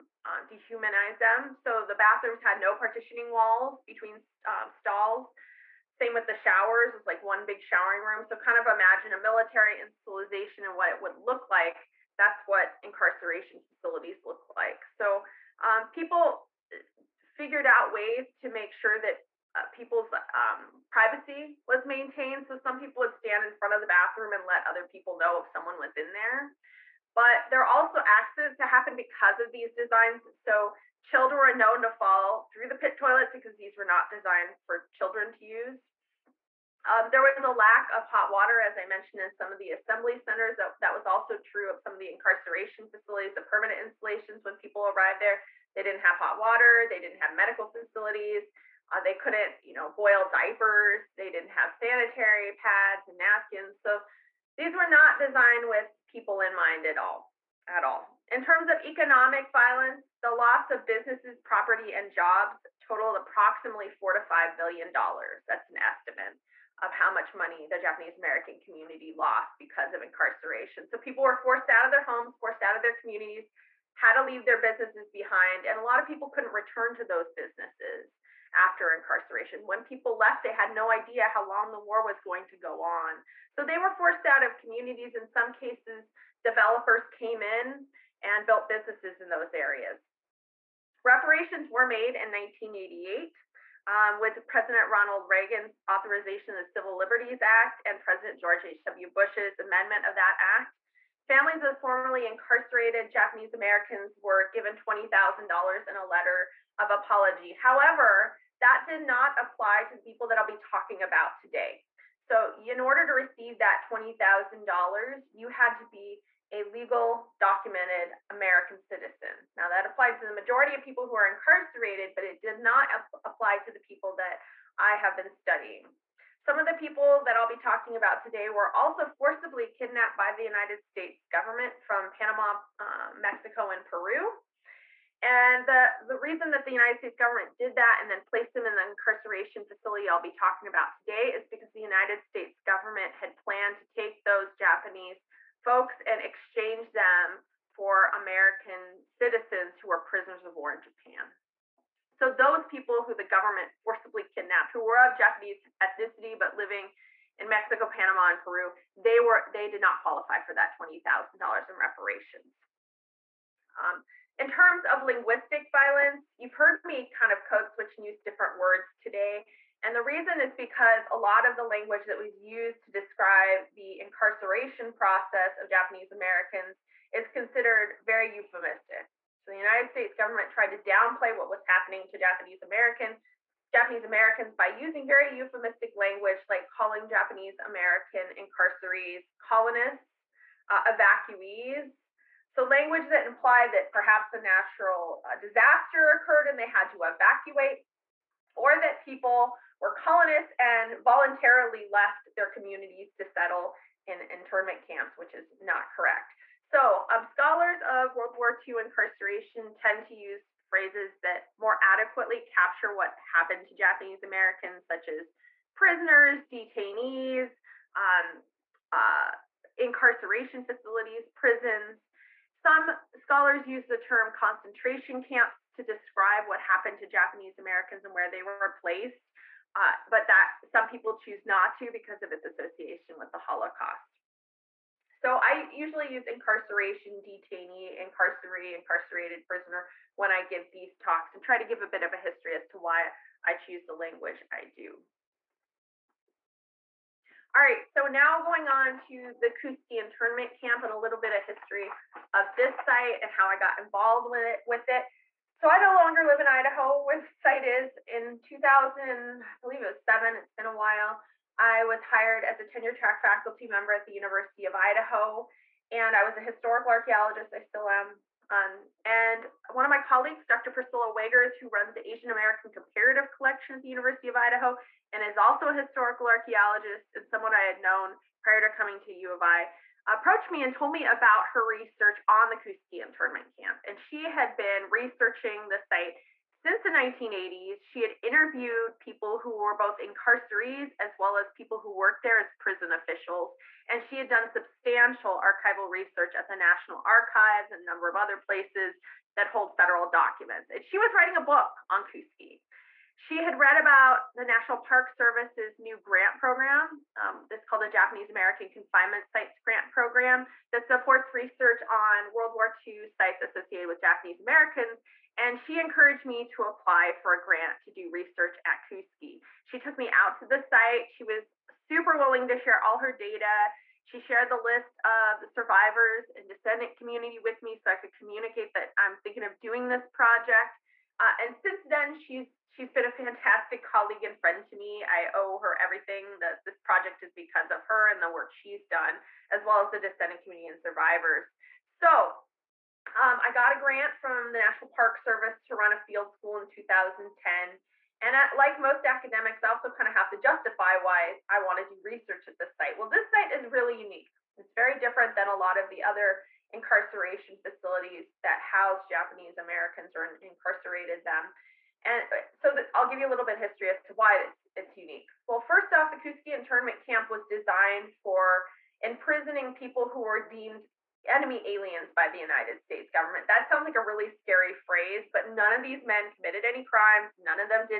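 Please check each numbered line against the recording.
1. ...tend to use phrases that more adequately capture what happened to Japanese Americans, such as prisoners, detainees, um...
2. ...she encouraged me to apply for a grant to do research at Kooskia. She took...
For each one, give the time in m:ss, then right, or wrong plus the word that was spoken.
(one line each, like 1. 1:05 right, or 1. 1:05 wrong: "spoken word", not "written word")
1. 3:29 right
2. 5:15 right.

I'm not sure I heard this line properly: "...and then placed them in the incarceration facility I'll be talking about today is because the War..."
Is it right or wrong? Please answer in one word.
wrong.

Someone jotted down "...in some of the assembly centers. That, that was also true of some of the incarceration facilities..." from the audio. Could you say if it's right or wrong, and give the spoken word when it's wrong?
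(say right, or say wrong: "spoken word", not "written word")
right.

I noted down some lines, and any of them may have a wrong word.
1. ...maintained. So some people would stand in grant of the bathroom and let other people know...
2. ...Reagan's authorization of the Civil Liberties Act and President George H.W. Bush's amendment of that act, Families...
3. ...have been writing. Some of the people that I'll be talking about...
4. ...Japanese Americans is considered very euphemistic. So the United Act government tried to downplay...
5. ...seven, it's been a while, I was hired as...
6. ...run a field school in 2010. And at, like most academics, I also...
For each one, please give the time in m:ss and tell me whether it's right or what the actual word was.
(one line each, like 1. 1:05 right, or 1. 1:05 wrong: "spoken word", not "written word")
1. 0:21 wrong: "front", not "grant"
2. 1:35 right
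3. 2:04 wrong: "studying", not "writing"
4. 2:55 wrong: "States", not "Act"
5. 4:20 right
6. 5:45 right.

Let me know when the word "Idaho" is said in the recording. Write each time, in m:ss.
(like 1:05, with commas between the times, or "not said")
4:16, 4:24, 4:34.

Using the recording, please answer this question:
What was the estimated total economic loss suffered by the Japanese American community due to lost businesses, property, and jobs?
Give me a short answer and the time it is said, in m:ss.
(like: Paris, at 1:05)
4 to 5 billion dollars, at 1:03.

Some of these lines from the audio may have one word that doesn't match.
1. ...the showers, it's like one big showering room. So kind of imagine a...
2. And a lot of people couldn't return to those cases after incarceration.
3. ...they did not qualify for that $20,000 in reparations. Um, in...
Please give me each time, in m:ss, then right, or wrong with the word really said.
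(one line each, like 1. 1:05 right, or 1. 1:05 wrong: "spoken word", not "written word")
1. 0:06 right
2. 1:15 wrong: "businesses", not "cases"
3. 2:39 right.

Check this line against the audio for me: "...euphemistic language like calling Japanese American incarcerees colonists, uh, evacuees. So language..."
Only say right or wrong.
right.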